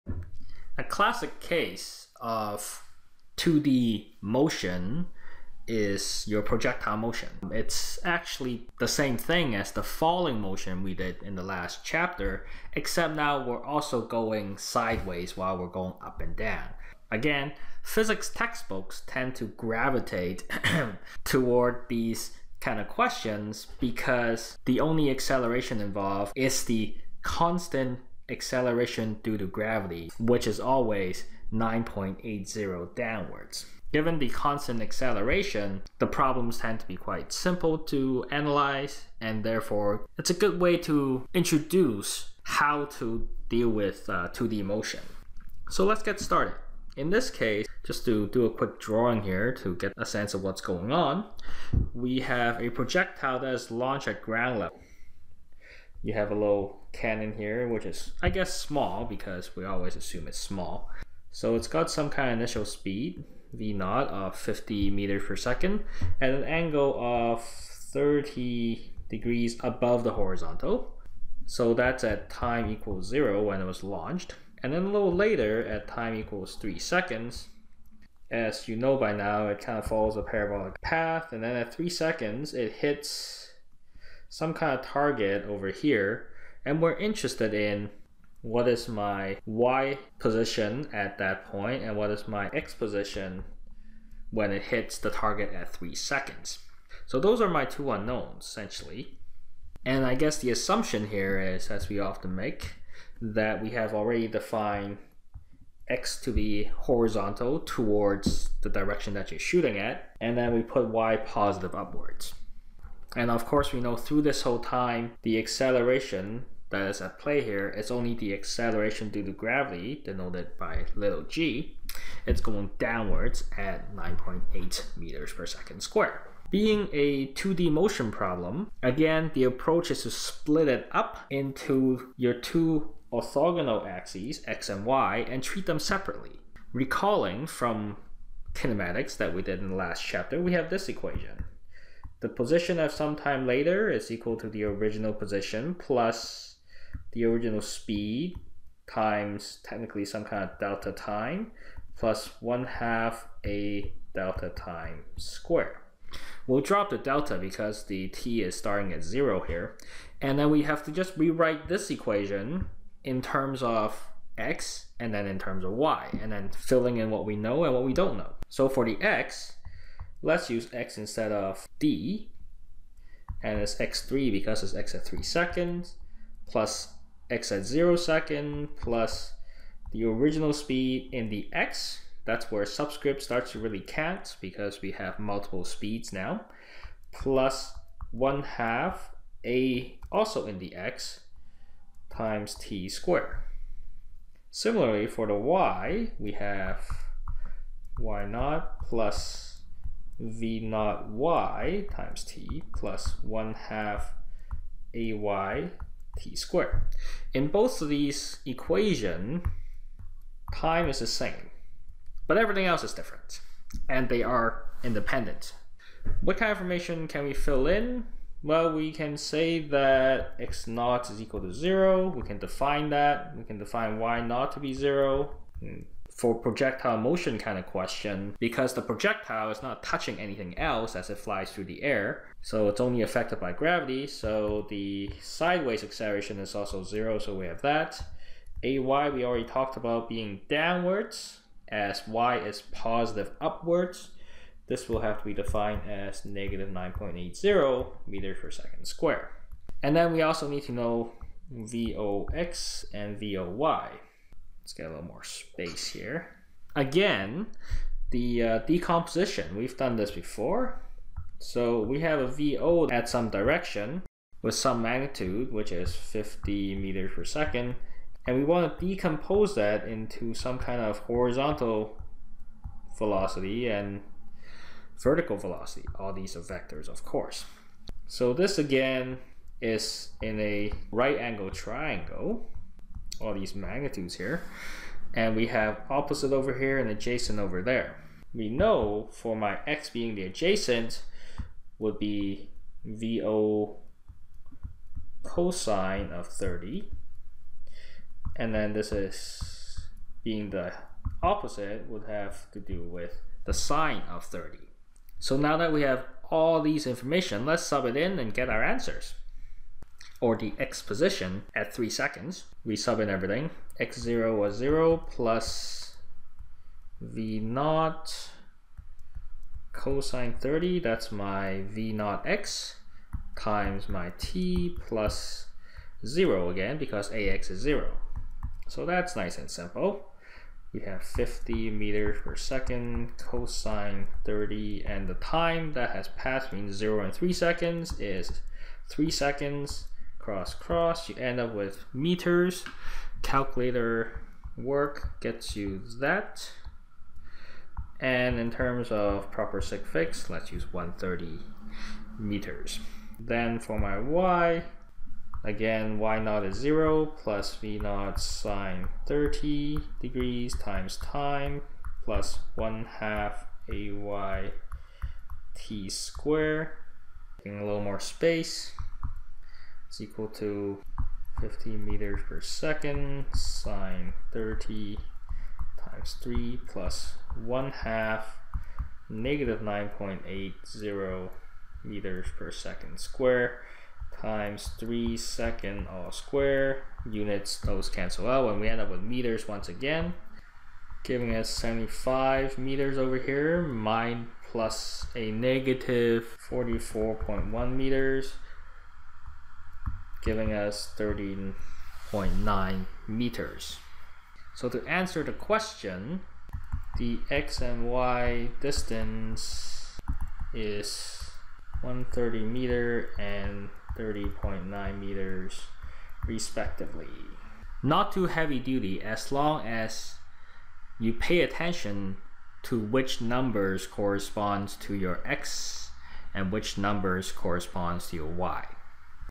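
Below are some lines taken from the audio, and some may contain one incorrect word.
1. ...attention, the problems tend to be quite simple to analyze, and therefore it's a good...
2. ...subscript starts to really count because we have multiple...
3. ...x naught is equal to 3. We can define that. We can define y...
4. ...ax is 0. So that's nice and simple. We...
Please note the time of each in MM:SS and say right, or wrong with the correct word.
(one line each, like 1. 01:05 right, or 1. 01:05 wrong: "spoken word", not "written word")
1. 00:34 wrong: "acceleration", not "attention"
2. 03:02 right
3. 03:40 wrong: "0", not "3"
4. 05:27 right.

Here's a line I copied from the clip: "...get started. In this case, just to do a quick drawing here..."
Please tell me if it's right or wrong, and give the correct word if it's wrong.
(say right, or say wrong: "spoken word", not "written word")
right.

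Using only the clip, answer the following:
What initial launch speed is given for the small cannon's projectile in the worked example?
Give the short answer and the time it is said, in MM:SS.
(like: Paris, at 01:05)
50 meters per second, at 01:03.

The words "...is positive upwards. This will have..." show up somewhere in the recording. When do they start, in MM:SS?
04:02.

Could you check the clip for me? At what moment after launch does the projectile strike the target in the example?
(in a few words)
3 seconds.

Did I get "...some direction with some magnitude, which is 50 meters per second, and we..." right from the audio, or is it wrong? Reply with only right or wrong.
right.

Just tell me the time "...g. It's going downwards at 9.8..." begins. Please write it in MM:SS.
02:01.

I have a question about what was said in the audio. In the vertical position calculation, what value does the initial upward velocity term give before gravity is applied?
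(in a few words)
75 meters.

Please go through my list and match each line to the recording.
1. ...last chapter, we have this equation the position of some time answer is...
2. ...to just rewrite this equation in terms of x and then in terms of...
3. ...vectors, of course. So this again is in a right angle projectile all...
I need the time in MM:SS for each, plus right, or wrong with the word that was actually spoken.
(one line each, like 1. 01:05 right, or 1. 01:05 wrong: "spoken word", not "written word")
1. 02:19 wrong: "later", not "answer"
2. 02:40 right
3. 04:36 wrong: "triangle", not "projectile".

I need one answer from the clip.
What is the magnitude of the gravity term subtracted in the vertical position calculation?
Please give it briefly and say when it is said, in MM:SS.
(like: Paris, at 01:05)
44.1 meters, at 06:36.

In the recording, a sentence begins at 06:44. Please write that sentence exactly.
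So to answer the question, the x and y distance is 130 meter and 30.9 meters respectively.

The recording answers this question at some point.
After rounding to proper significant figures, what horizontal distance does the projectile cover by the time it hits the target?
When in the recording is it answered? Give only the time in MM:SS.
05:50.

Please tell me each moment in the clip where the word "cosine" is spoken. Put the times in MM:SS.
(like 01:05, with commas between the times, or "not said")
04:55, 05:19, 05:33.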